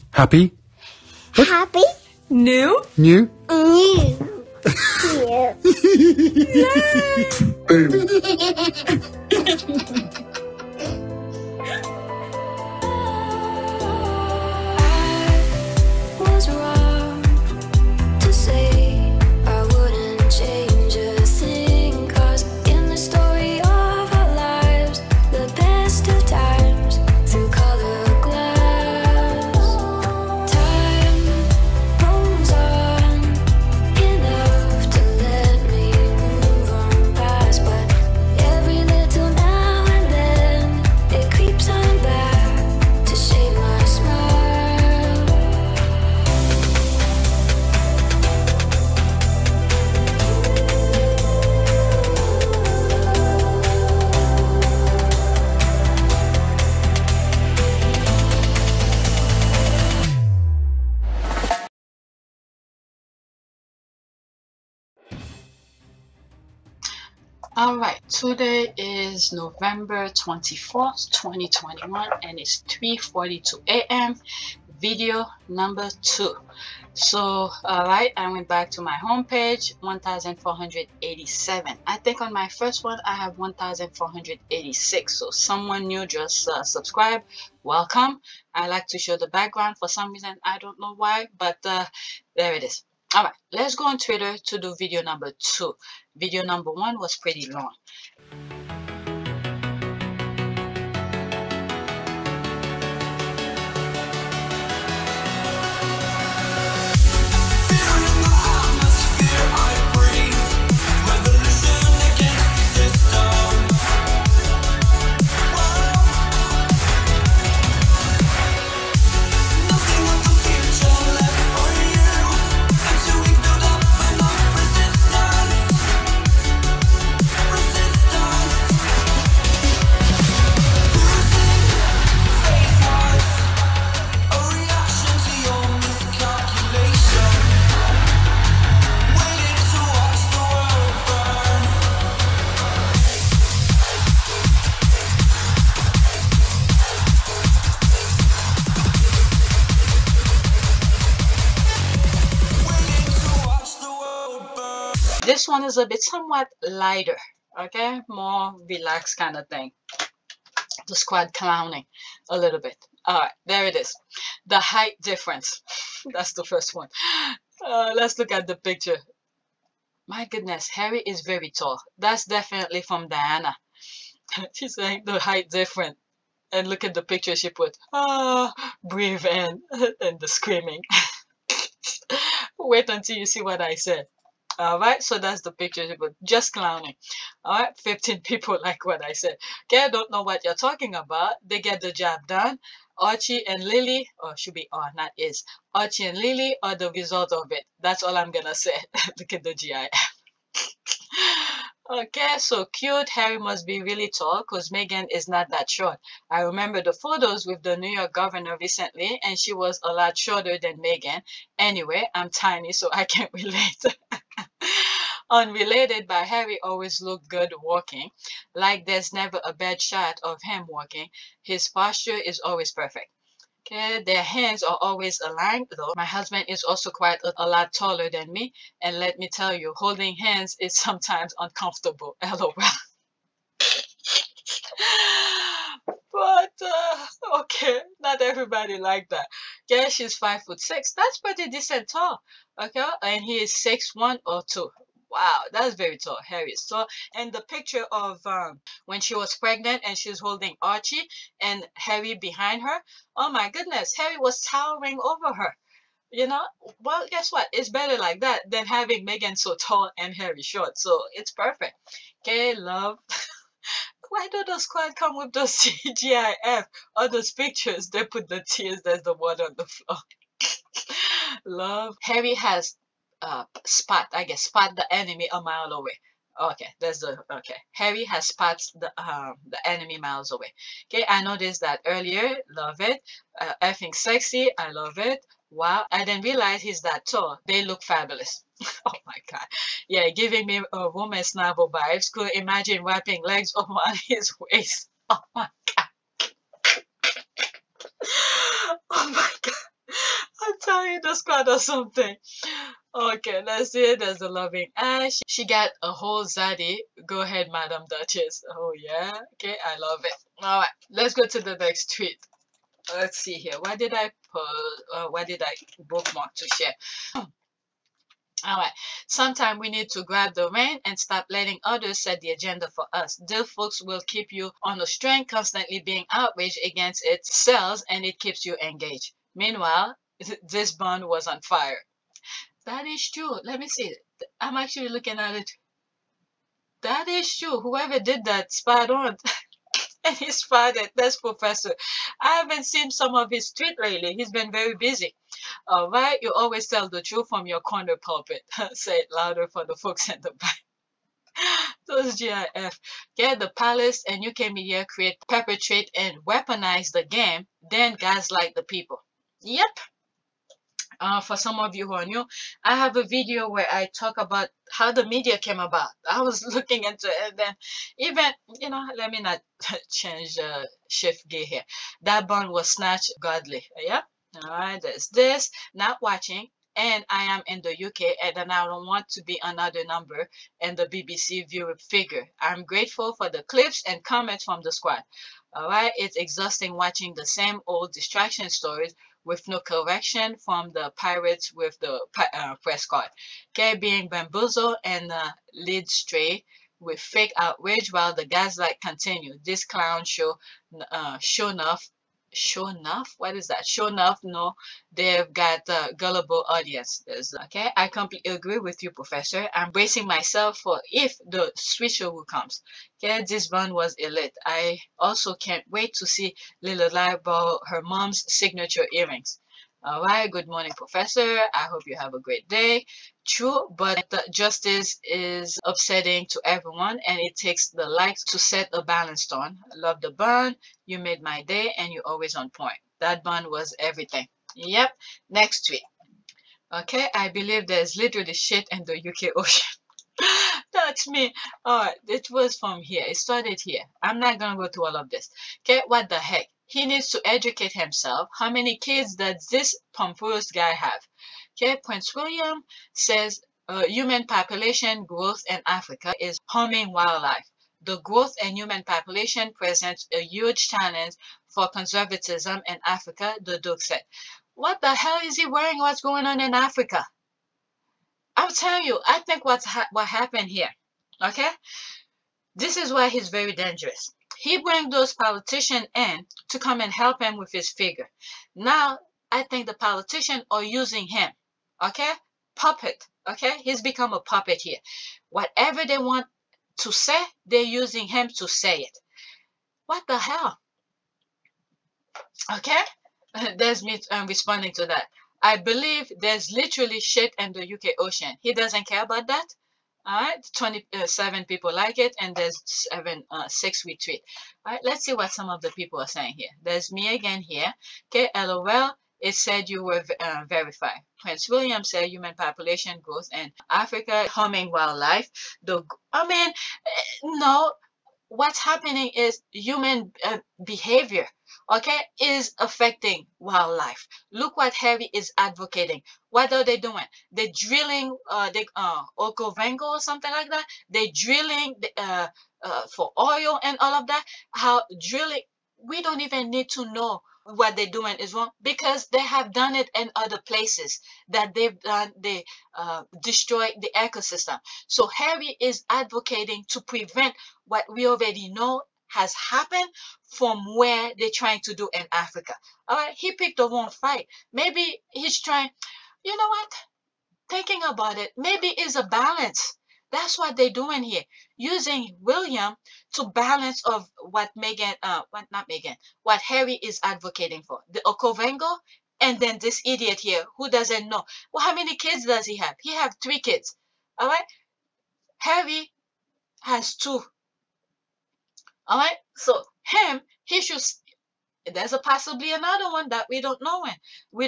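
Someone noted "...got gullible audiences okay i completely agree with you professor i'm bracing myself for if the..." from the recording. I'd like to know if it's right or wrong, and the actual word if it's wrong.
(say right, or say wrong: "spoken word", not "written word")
right.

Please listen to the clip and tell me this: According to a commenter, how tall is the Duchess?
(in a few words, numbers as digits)
five foot six.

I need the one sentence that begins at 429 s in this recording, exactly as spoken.
Love the bun, you made my day, and you're always on point.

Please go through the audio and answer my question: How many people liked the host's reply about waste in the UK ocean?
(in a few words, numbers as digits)
27.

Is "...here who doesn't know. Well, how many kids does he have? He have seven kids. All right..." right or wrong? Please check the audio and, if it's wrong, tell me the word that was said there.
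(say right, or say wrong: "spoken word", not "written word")
wrong: "three", not "seven".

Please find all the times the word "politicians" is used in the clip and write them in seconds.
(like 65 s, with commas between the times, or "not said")
475 s, 479 s.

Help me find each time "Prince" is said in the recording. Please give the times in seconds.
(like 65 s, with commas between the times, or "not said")
451 s, 511 s.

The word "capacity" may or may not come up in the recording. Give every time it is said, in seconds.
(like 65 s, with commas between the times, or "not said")
not said.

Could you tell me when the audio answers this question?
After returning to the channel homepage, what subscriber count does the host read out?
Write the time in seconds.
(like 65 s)
79 s.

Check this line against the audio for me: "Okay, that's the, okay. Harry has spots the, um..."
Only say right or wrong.
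right.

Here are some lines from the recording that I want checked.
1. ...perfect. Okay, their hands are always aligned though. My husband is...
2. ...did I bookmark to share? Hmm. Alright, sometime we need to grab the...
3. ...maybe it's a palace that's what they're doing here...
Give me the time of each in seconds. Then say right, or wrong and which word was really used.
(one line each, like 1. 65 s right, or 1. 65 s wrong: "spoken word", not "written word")
1. 222 s right
2. 315 s right
3. 558 s wrong: "balance", not "palace".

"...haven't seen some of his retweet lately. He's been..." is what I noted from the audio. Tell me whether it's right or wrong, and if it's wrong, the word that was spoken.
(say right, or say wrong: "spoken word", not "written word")
wrong: "tweet", not "retweet".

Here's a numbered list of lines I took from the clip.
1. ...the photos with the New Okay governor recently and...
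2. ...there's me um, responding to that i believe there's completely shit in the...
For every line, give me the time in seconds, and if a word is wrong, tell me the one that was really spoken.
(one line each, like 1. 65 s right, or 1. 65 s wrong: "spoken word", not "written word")
1. 206 s wrong: "York", not "Okay"
2. 493 s wrong: "literally", not "completely".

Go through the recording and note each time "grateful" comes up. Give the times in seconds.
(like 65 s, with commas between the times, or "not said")
382 s.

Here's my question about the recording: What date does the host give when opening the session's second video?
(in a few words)
November 24th, 2021.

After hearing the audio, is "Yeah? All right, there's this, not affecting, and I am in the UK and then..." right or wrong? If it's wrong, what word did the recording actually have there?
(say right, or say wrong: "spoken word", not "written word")
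wrong: "watching", not "affecting".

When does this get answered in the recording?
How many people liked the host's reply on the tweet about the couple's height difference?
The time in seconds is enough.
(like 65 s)
187 s.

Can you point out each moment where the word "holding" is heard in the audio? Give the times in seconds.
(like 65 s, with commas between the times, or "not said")
229 s, 250 s.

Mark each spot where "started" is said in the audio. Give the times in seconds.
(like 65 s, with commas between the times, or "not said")
443 s.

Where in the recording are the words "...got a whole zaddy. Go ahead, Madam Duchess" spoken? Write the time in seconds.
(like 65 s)
305 s.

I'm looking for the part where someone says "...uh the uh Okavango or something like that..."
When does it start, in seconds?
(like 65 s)
528 s.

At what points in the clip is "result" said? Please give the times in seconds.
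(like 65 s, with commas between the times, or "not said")
196 s.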